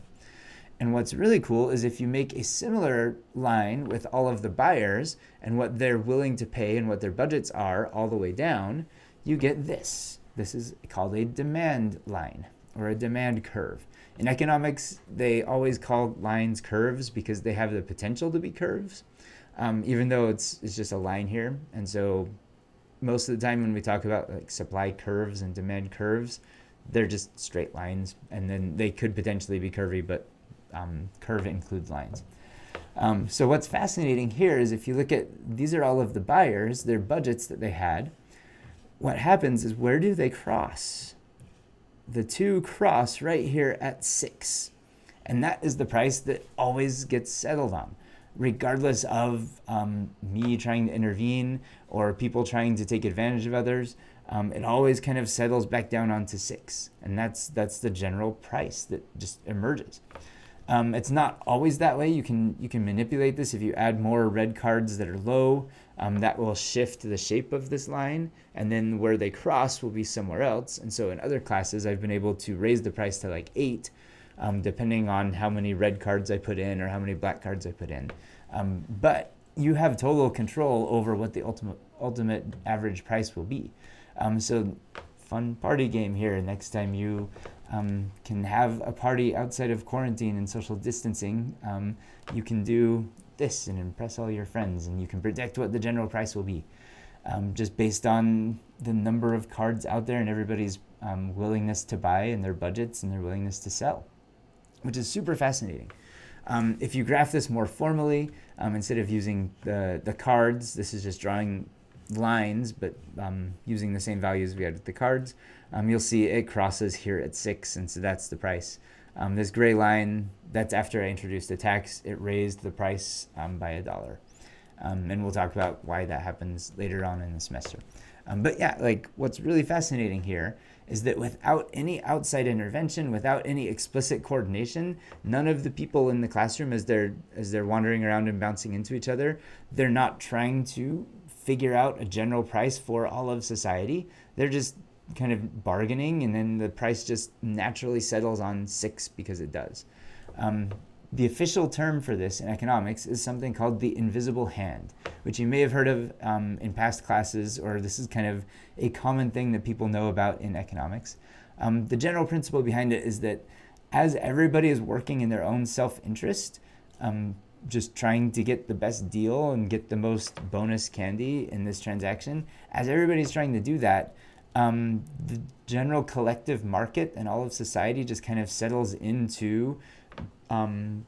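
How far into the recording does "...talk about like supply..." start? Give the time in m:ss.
0:23.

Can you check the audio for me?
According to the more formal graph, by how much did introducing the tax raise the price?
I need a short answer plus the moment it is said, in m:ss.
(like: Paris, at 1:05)
a dollar, at 2:03.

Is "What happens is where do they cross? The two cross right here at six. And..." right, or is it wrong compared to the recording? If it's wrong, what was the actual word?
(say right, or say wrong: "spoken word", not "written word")
right.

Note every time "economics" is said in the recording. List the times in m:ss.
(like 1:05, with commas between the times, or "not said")
0:14, 2:32, 2:40.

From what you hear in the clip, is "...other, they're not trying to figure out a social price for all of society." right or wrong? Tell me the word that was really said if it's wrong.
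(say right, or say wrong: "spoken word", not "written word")
wrong: "general", not "social".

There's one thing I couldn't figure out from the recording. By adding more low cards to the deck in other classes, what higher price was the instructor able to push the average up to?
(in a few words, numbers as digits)
8.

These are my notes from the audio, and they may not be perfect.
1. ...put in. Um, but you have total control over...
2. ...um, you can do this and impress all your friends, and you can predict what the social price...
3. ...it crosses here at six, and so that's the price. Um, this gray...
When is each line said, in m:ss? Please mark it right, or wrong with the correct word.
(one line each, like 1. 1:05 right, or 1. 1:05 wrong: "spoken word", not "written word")
1. 1:17 right
2. 1:31 wrong: "general", not "social"
3. 1:56 right.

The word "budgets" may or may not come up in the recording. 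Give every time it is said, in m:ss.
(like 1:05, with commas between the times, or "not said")
0:07, 0:36, 1:42.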